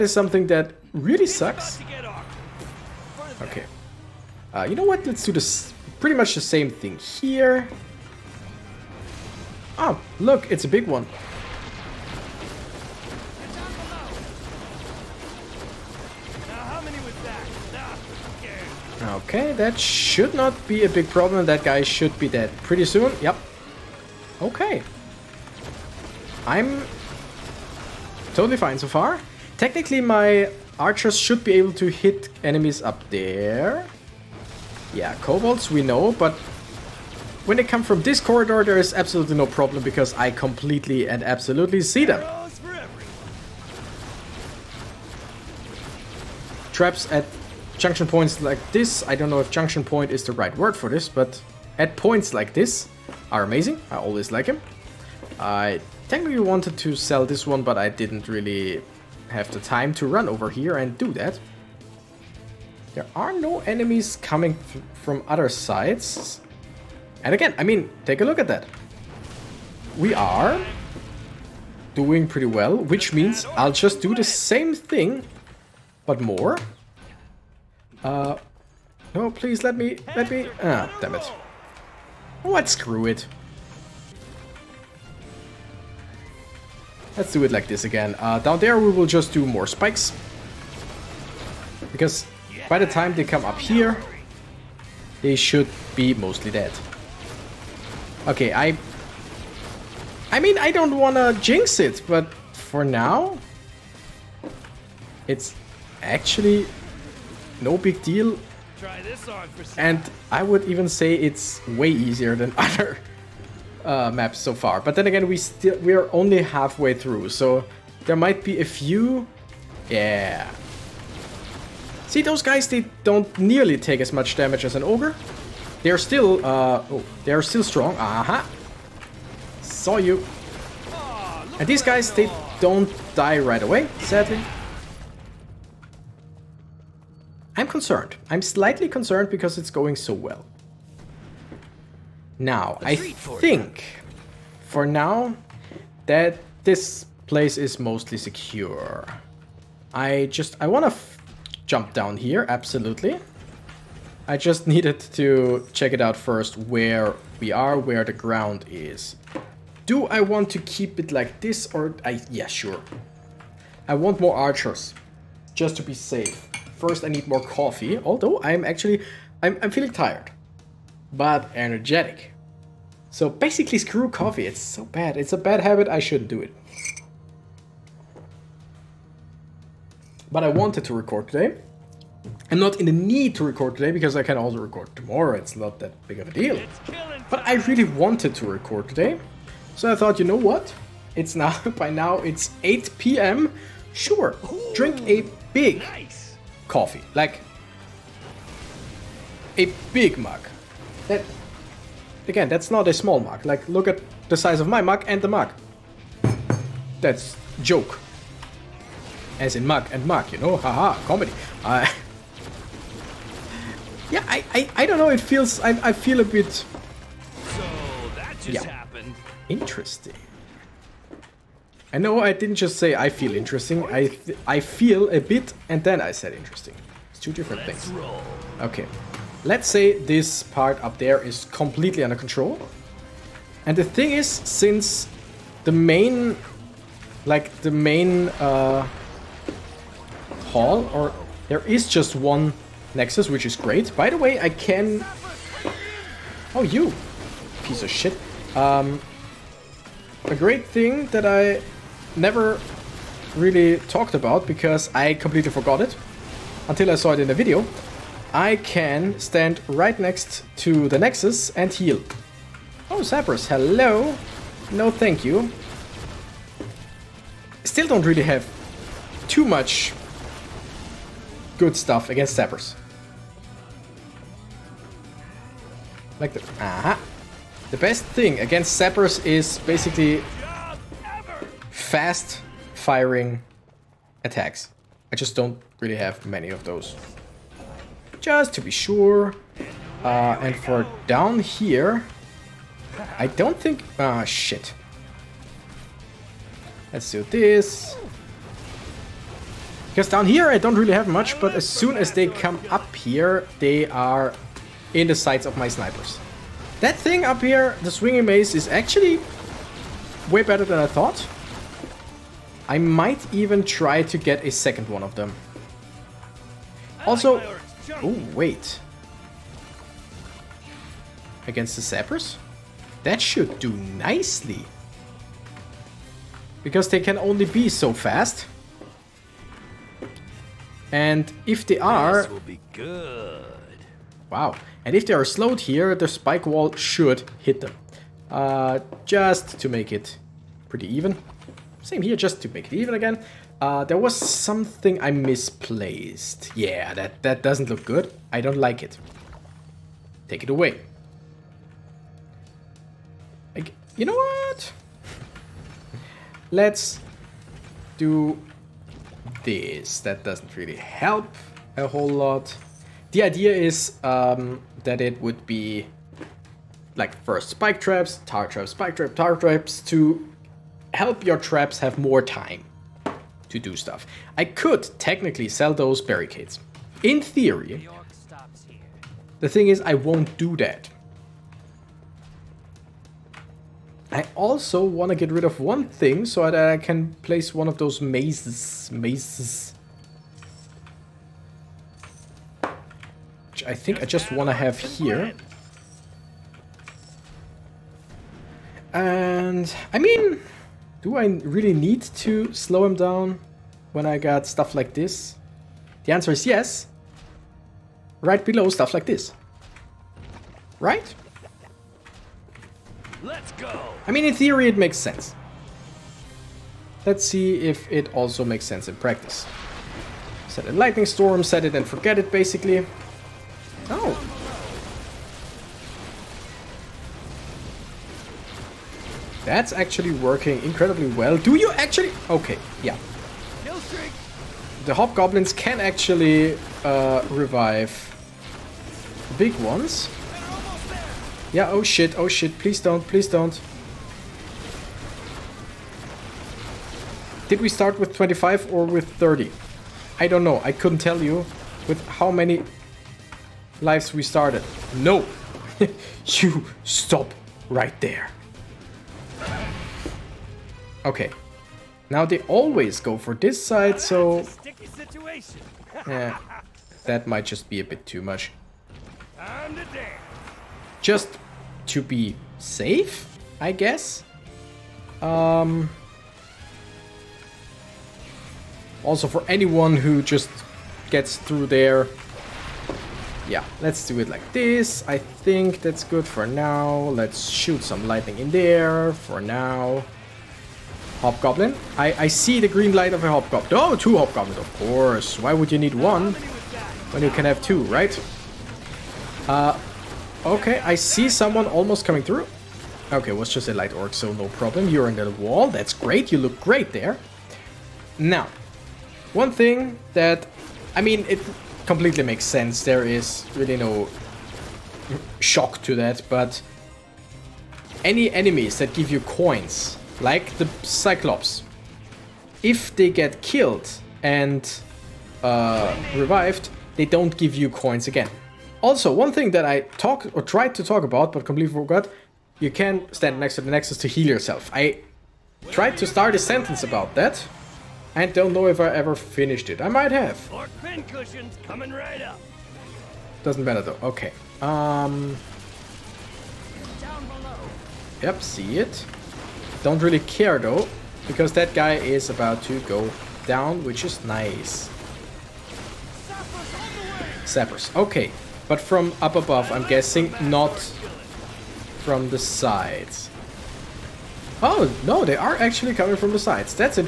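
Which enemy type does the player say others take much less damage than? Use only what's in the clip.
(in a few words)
ogre.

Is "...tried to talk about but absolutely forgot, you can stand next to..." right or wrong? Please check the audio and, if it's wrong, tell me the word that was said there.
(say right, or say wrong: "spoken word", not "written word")
wrong: "completely", not "absolutely".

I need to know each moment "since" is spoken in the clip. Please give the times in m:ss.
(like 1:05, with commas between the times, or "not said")
3:54.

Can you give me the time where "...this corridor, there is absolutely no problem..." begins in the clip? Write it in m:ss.
0:38.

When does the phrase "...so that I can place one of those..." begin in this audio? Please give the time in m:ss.
6:26.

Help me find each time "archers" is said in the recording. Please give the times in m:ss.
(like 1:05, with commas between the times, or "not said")
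0:30, 2:44.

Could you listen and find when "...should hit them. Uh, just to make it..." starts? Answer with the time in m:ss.
5:36.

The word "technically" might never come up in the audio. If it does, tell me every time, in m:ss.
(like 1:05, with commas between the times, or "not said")
0:29, 0:56, 6:14.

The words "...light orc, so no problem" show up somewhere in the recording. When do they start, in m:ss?
8:23.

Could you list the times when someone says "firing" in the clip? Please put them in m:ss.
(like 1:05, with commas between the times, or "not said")
4:42.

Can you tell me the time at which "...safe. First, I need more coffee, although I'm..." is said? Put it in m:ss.
2:45.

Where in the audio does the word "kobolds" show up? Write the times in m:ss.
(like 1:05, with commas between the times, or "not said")
0:35.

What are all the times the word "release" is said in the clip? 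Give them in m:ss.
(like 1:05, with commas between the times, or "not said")
not said.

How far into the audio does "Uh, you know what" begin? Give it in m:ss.
0:04.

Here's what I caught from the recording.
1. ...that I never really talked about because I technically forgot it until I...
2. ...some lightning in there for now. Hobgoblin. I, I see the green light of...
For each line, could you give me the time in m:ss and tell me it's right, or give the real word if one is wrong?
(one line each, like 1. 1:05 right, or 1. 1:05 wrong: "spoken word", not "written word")
1. 4:11 wrong: "completely", not "technically"
2. 8:07 right.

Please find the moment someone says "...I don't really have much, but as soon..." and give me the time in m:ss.
5:00.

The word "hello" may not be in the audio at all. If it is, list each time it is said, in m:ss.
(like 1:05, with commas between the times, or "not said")
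4:23.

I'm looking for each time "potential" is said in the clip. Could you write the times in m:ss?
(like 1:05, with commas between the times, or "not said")
not said.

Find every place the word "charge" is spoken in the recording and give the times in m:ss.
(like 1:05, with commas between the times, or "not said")
not said.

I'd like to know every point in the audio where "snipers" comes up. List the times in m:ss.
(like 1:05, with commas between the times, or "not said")
5:05.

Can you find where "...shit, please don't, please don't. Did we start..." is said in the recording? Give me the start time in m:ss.
7:22.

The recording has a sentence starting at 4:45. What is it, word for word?
I just don't really have many of those.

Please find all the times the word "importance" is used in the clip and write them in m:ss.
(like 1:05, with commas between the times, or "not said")
not said.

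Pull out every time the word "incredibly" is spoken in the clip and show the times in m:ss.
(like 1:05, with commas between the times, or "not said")
7:10.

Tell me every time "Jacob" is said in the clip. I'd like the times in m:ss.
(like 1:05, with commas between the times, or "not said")
not said.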